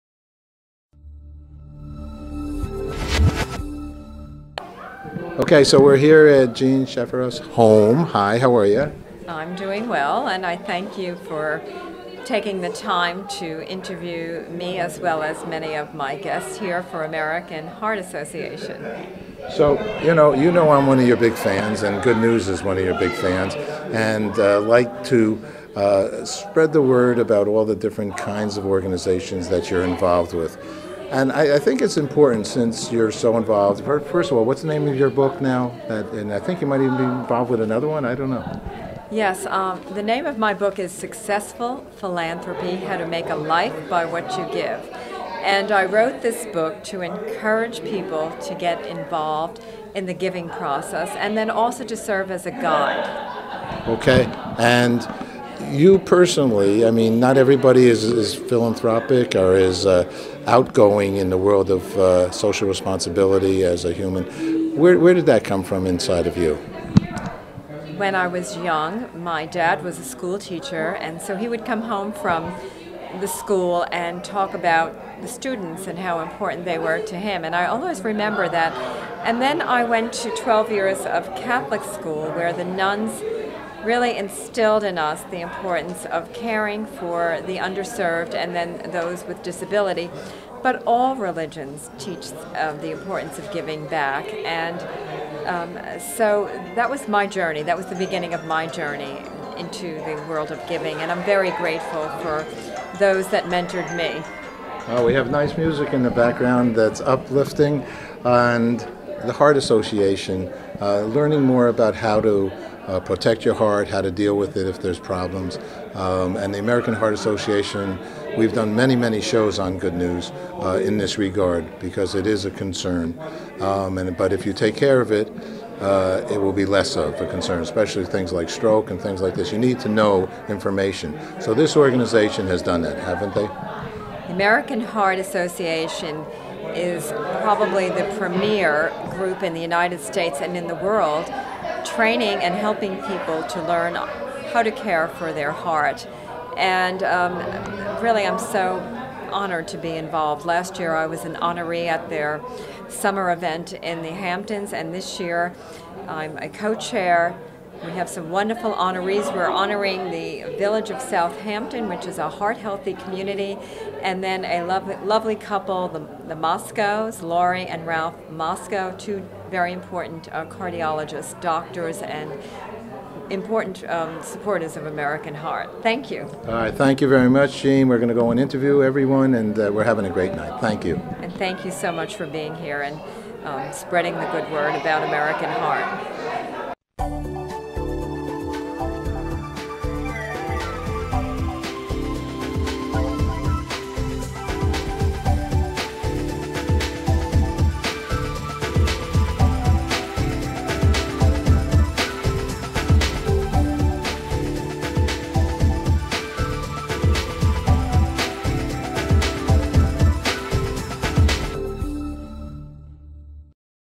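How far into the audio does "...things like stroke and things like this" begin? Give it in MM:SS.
02:08.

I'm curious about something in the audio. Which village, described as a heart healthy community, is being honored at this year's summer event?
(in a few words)
Southampton.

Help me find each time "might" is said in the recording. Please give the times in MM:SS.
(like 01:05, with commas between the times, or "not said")
00:36.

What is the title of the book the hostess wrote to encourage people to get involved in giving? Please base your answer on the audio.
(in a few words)
Successful Philanthropy.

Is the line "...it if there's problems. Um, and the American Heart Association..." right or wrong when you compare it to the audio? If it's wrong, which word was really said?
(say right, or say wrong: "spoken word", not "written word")
right.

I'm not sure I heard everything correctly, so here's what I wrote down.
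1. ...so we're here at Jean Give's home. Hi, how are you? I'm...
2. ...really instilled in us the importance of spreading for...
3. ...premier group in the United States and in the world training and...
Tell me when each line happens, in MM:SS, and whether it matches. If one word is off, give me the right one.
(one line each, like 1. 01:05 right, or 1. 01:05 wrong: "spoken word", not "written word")
1. 00:05 wrong: "Shafiroff", not "Give"
2. 01:23 wrong: "caring", not "spreading"
3. 02:18 right.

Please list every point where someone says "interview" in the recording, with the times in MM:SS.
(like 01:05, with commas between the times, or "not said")
00:13, 02:58.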